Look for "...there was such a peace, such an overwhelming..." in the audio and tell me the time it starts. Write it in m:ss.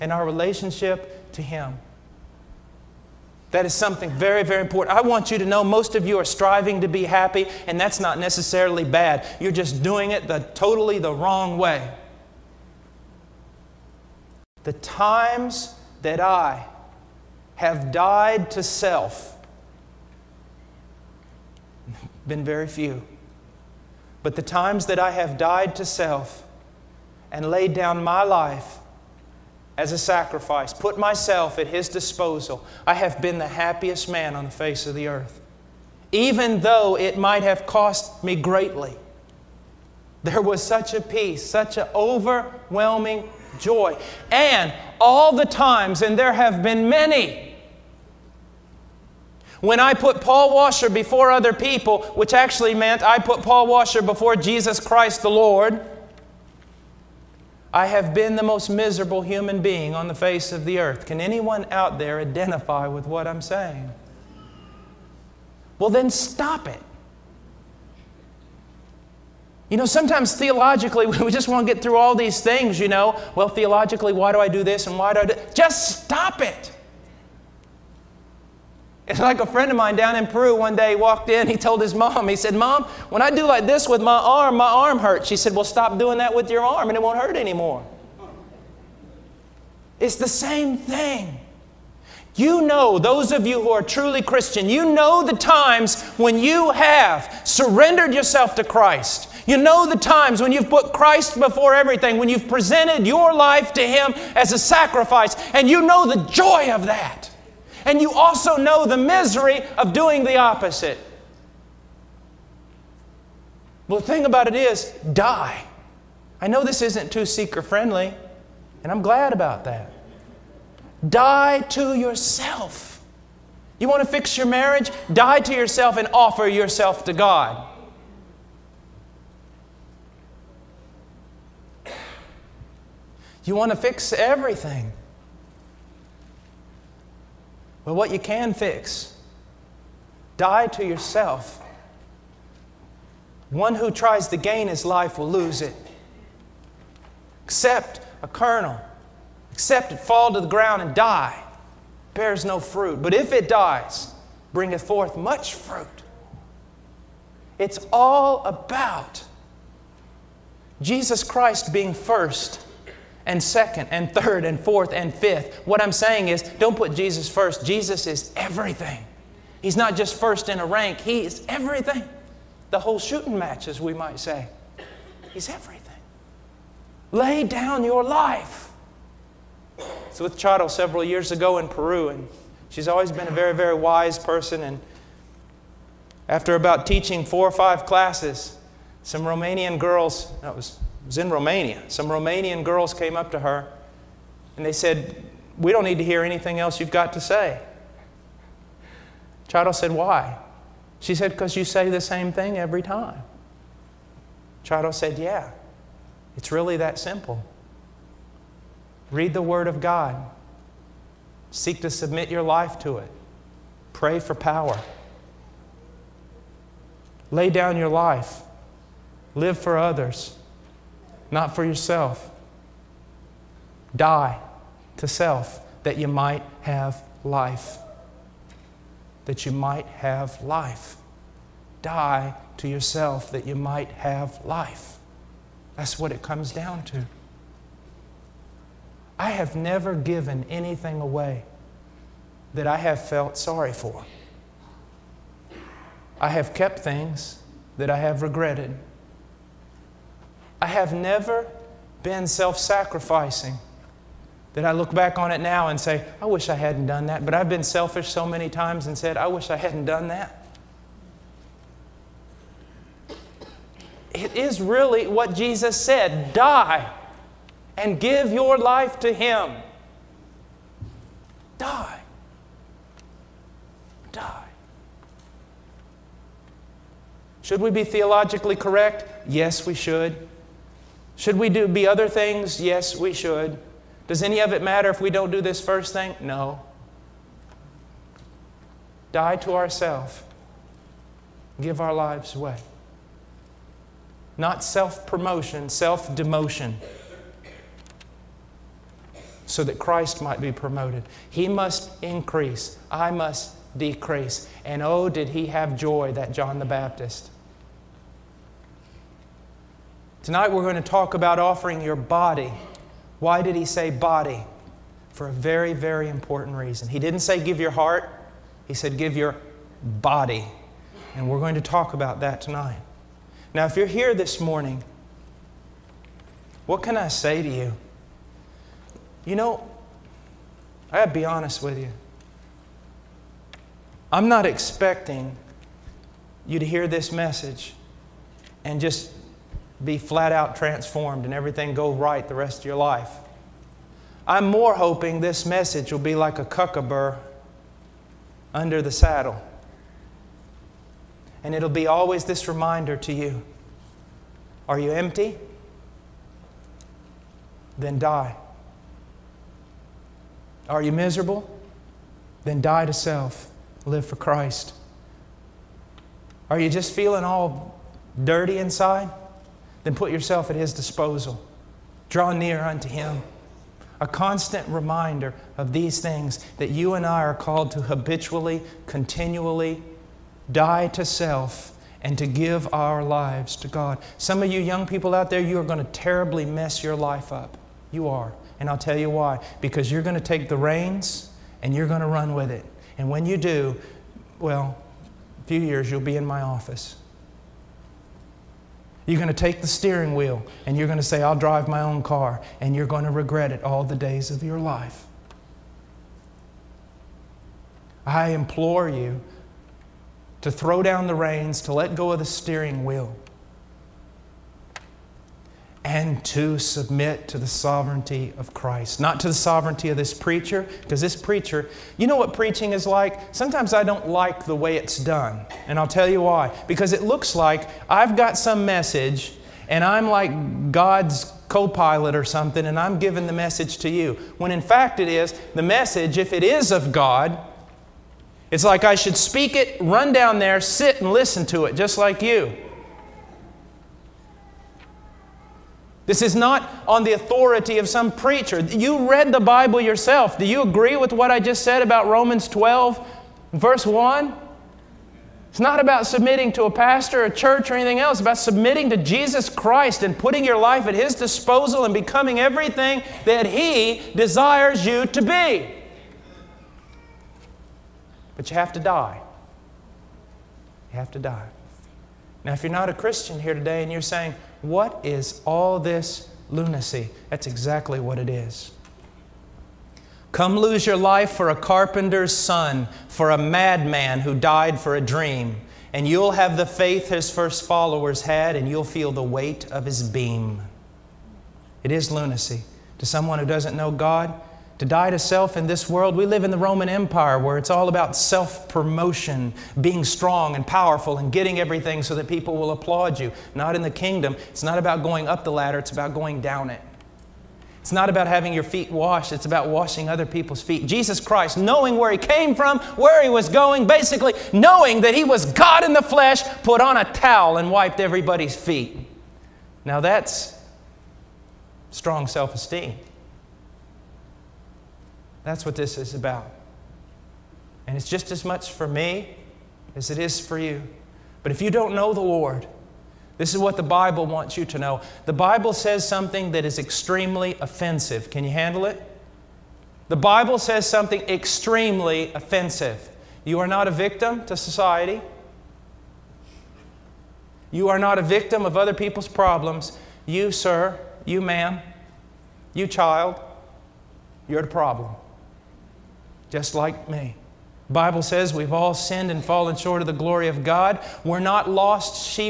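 0:40.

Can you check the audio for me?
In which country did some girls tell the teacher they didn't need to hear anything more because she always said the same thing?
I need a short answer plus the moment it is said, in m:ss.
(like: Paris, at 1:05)
Romania, at 3:11.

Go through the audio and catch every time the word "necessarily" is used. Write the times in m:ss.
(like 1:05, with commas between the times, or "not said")
0:08.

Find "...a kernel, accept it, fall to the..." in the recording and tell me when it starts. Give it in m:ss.
2:28.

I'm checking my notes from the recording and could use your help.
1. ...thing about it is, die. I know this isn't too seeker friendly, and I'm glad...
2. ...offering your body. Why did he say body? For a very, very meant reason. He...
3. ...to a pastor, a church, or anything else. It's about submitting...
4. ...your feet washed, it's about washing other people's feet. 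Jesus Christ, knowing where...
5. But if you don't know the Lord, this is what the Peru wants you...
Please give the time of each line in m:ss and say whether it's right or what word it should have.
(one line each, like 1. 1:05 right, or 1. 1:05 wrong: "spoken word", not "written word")
1. 1:54 right
2. 5:11 wrong: "important", not "meant"
3. 7:36 right
4. 8:28 right
5. 8:51 wrong: "Bible", not "Peru".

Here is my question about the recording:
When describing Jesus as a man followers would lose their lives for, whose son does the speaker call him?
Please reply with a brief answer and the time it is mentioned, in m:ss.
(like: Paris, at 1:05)
A carpenter's son, at 8:01.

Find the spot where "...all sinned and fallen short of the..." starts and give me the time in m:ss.
9:18.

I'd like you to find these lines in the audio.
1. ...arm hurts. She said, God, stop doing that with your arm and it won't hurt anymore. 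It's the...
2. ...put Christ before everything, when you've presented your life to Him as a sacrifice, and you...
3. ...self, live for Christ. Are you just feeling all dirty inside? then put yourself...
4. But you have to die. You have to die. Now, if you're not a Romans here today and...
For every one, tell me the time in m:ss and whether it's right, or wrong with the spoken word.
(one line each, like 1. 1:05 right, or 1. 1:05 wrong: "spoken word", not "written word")
1. 1:24 wrong: "Well", not "God"
2. 1:40 right
3. 6:02 right
4. 7:48 wrong: "Christian", not "Romans".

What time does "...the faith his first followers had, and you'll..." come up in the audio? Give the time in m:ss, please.
8:06.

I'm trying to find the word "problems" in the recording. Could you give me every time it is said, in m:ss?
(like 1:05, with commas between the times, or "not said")
9:09, 9:14.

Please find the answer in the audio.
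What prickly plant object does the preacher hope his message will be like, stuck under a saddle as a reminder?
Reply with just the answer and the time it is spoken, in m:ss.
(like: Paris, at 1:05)
Cocklebur, at 5:46.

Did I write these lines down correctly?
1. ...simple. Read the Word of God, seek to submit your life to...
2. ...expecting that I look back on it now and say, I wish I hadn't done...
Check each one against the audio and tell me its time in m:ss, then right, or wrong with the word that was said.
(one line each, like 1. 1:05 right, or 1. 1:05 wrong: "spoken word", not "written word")
1. 3:26 right
2. 4:12 wrong: "sacrificing", not "expecting".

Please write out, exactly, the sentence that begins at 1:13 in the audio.
Well, theologically, why do I do this and why do I do Just stop it.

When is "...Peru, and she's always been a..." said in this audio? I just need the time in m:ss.
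3:01.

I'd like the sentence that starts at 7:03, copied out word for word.
Sometimes I don't like the way it's done, and I'll tell you why.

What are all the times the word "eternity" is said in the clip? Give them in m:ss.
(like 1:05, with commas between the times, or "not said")
not said.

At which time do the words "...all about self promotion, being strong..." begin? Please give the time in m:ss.
8:17.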